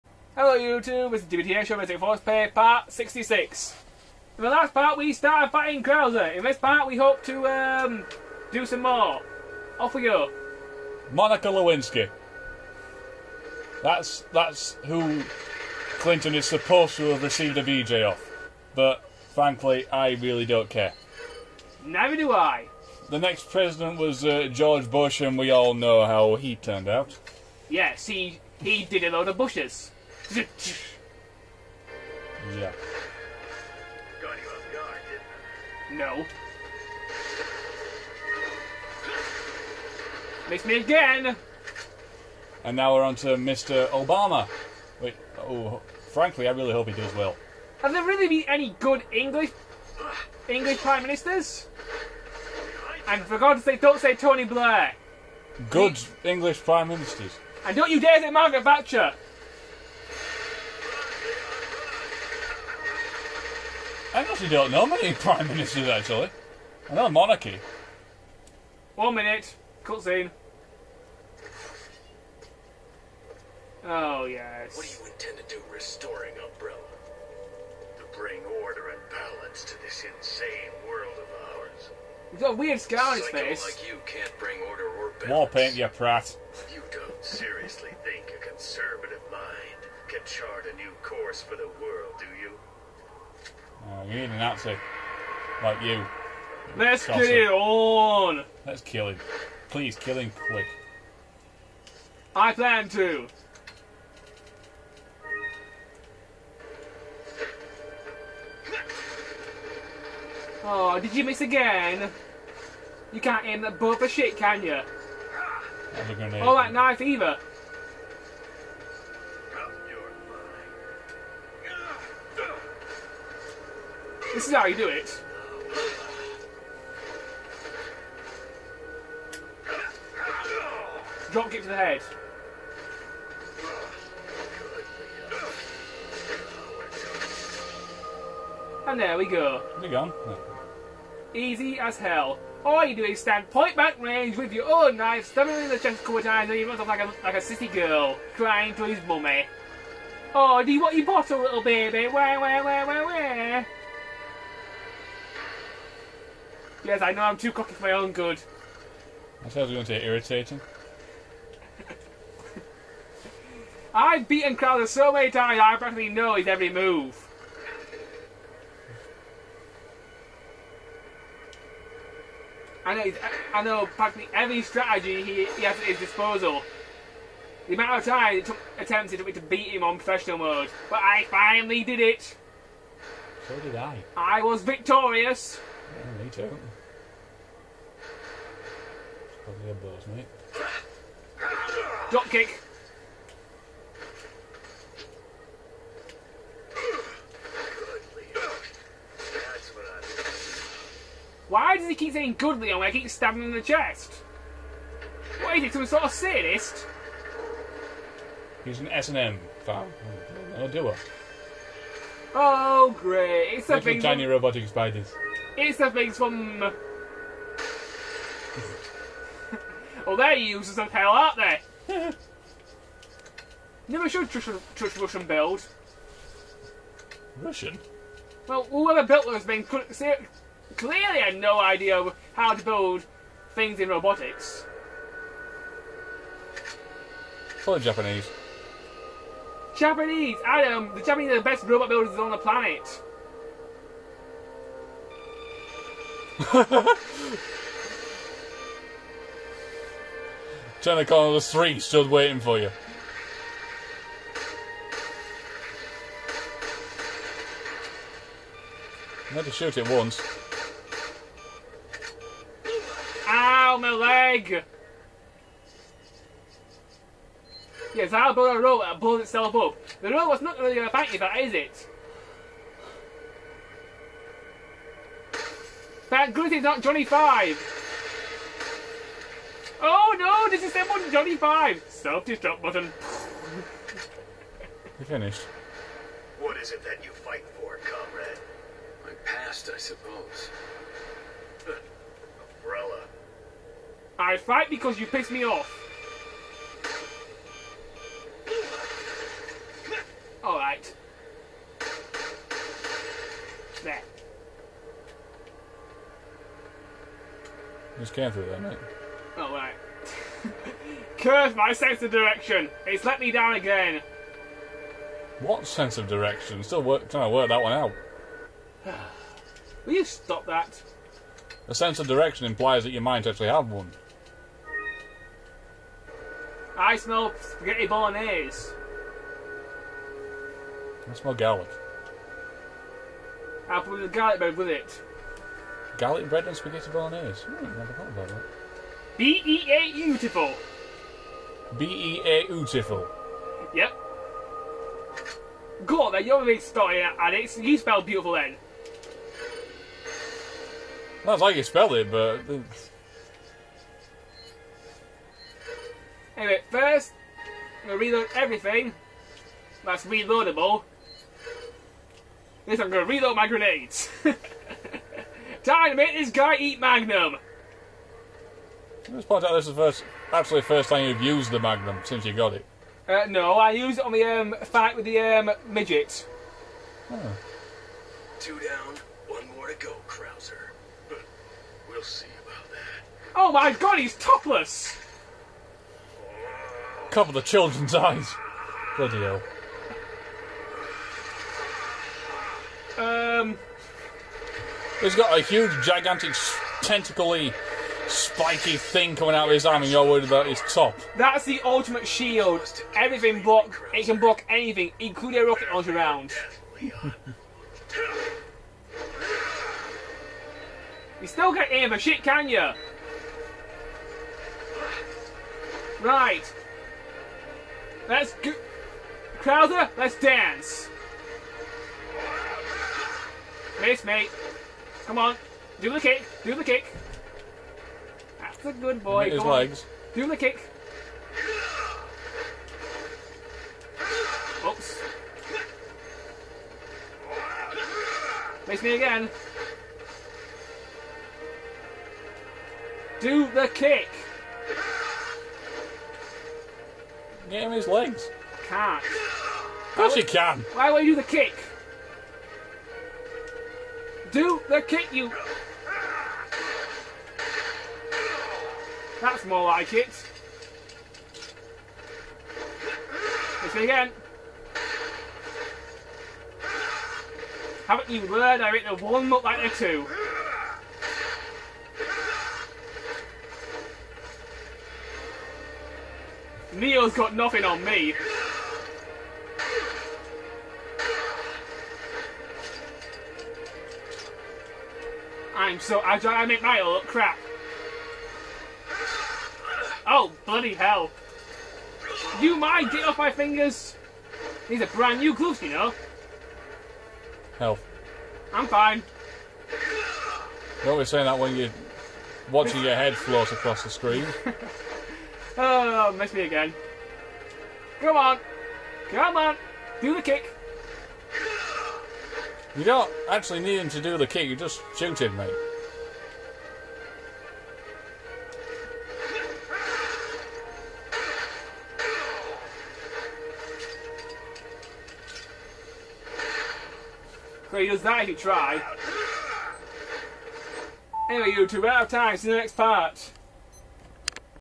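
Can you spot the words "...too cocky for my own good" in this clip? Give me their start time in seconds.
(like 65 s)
157 s.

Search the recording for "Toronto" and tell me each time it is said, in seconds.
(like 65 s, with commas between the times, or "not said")
not said.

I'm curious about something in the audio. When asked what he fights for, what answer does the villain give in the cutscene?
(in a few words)
My past.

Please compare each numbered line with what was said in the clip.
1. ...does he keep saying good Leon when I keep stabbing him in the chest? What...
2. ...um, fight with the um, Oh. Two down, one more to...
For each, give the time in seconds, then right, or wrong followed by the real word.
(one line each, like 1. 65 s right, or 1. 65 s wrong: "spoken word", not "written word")
1. 201 s right
2. 374 s right.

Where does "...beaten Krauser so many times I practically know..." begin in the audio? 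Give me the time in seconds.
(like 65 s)
164 s.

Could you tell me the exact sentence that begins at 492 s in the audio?
You might get off my fingers.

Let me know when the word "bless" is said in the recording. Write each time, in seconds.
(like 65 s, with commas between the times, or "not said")
not said.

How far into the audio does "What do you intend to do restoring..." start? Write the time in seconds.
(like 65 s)
74 s.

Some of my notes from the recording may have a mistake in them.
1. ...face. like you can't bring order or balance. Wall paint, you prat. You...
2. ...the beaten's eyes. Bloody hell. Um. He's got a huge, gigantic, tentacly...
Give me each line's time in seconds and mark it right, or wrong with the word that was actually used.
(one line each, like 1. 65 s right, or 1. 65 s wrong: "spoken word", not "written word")
1. 83 s right
2. 387 s wrong: "children", not "beaten".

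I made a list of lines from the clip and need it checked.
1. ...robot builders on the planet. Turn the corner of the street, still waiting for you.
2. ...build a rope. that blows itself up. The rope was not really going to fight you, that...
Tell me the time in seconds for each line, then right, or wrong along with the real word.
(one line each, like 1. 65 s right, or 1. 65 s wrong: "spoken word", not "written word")
1. 241 s right
2. 268 s right.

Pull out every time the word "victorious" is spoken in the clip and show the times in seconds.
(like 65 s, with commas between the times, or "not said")
184 s.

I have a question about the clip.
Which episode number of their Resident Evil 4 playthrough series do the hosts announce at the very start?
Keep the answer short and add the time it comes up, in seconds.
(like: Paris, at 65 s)
66, at 2 s.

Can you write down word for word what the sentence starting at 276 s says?
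That good is not Johnny Five.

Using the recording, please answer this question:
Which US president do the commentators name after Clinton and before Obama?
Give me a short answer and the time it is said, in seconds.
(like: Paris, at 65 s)
George Bush, at 24 s.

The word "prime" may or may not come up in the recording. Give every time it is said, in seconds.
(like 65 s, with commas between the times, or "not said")
50 s, 56 s, 65 s.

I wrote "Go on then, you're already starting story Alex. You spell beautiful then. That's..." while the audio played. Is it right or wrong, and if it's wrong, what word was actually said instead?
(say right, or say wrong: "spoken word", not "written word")
right.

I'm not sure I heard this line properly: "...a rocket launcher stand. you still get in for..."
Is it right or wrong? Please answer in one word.
wrong.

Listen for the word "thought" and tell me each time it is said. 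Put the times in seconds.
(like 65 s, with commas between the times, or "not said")
159 s, 337 s.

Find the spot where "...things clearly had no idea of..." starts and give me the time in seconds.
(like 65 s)
229 s.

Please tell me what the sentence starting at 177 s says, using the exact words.
The amount of time it took took me to beat him on professional mode, but I finally did it.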